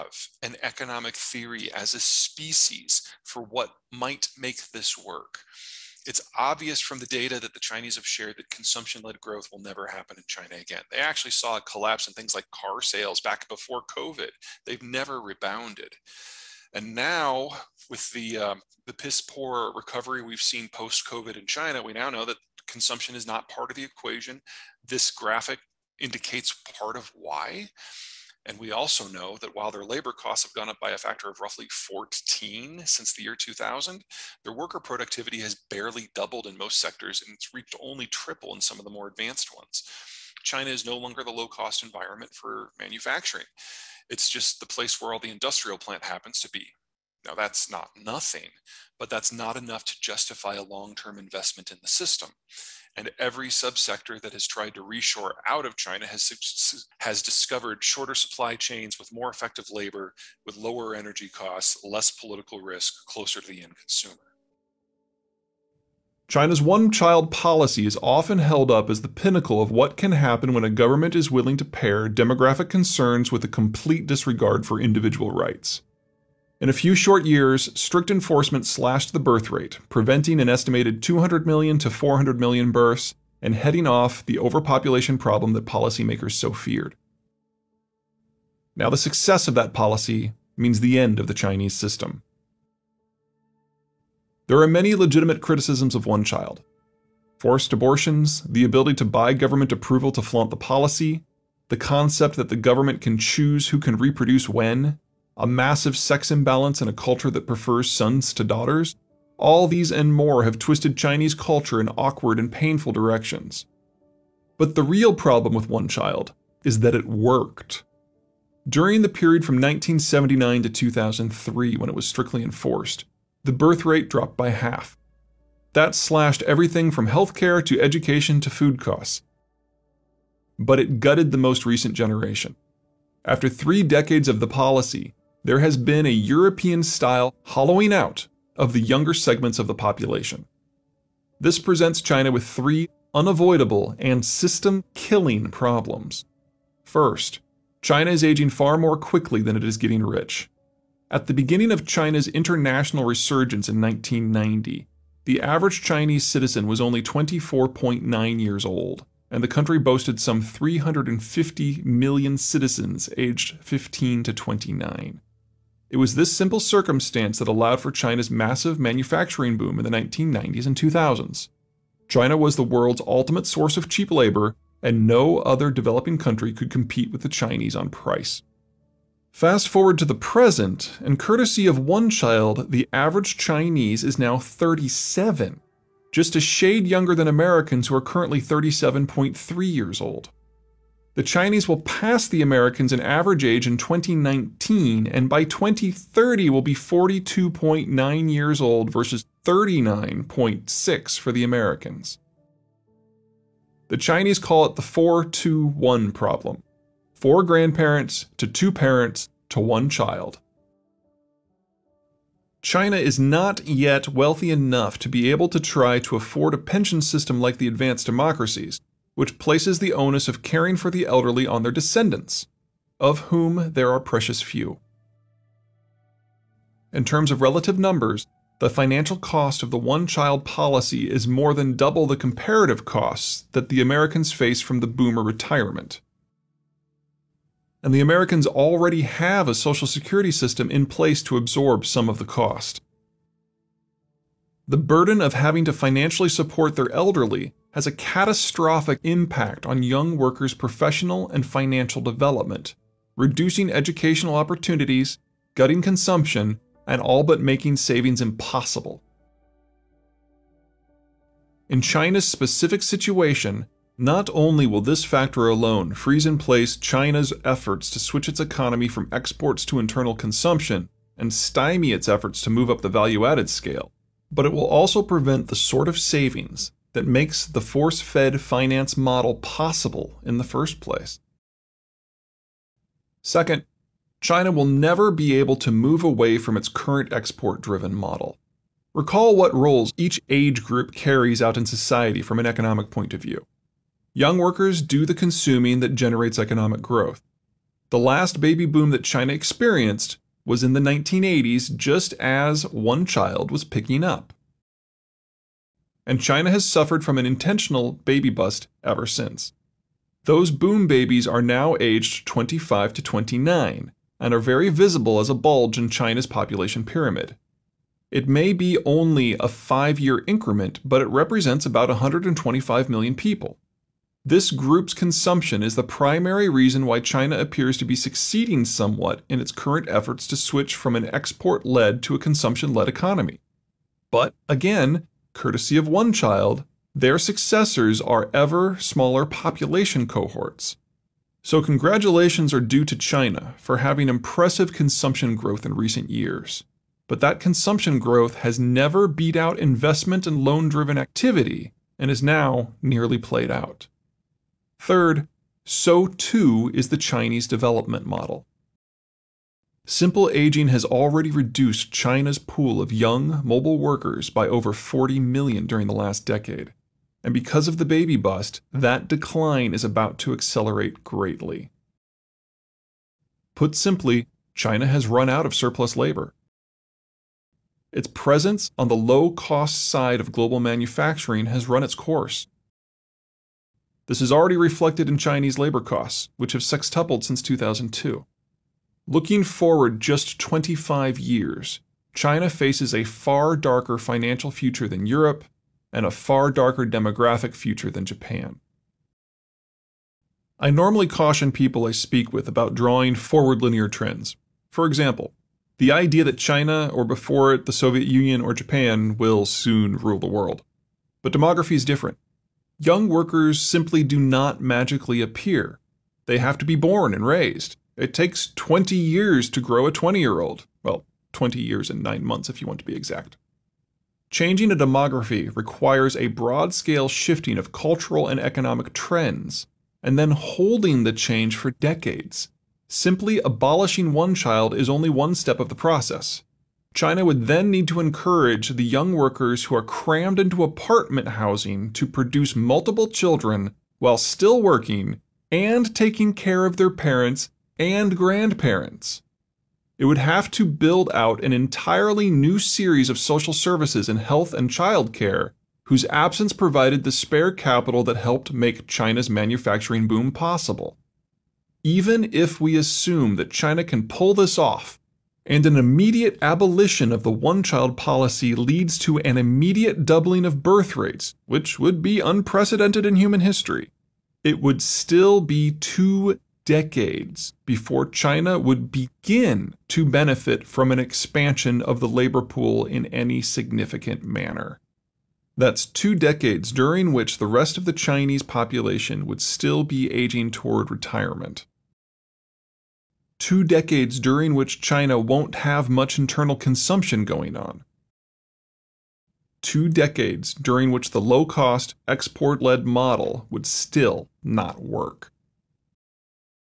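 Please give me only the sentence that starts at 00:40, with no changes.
China is no longer the low cost environment for manufacturing.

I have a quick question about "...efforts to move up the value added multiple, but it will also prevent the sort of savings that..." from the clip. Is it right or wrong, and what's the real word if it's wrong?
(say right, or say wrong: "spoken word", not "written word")
wrong: "scale", not "multiple".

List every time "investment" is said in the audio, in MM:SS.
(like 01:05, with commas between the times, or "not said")
00:51, 05:49.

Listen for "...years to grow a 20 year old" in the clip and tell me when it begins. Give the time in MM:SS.
06:58.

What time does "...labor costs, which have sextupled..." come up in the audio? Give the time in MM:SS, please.
06:25.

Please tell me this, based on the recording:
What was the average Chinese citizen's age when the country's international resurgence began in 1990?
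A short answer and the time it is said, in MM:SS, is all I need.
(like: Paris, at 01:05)
24.9, at 02:37.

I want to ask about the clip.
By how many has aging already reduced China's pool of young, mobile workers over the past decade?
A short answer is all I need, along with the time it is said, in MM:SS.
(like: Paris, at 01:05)
40 million, at 06:04.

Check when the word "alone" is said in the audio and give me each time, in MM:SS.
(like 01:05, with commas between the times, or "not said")
04:25.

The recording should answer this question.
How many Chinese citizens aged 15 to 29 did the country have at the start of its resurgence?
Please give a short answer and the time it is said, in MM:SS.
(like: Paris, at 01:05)
350 million, at 02:40.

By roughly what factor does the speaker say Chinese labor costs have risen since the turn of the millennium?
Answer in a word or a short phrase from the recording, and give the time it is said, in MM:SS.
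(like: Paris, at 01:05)
14, at 00:31.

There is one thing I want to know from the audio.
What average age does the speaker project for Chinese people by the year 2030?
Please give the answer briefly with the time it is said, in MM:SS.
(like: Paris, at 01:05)
42.9, at 03:16.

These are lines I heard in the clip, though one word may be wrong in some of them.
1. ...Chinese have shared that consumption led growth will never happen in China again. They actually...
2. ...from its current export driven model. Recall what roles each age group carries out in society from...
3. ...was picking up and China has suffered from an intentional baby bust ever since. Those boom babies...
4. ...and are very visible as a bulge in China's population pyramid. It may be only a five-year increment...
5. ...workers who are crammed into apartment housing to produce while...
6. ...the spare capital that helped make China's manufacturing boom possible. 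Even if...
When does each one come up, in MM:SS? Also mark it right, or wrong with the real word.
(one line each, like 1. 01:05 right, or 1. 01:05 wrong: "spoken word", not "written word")
1. 00:07 right
2. 04:46 right
3. 05:03 right
4. 05:14 right
5. 07:19 wrong: "multiple", not "while"
6. 07:37 right.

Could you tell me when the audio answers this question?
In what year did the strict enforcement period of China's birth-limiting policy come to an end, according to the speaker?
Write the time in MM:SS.
02:00.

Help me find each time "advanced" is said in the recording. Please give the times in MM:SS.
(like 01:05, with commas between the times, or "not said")
00:39, 03:37.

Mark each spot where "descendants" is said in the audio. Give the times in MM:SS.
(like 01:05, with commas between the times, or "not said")
03:41.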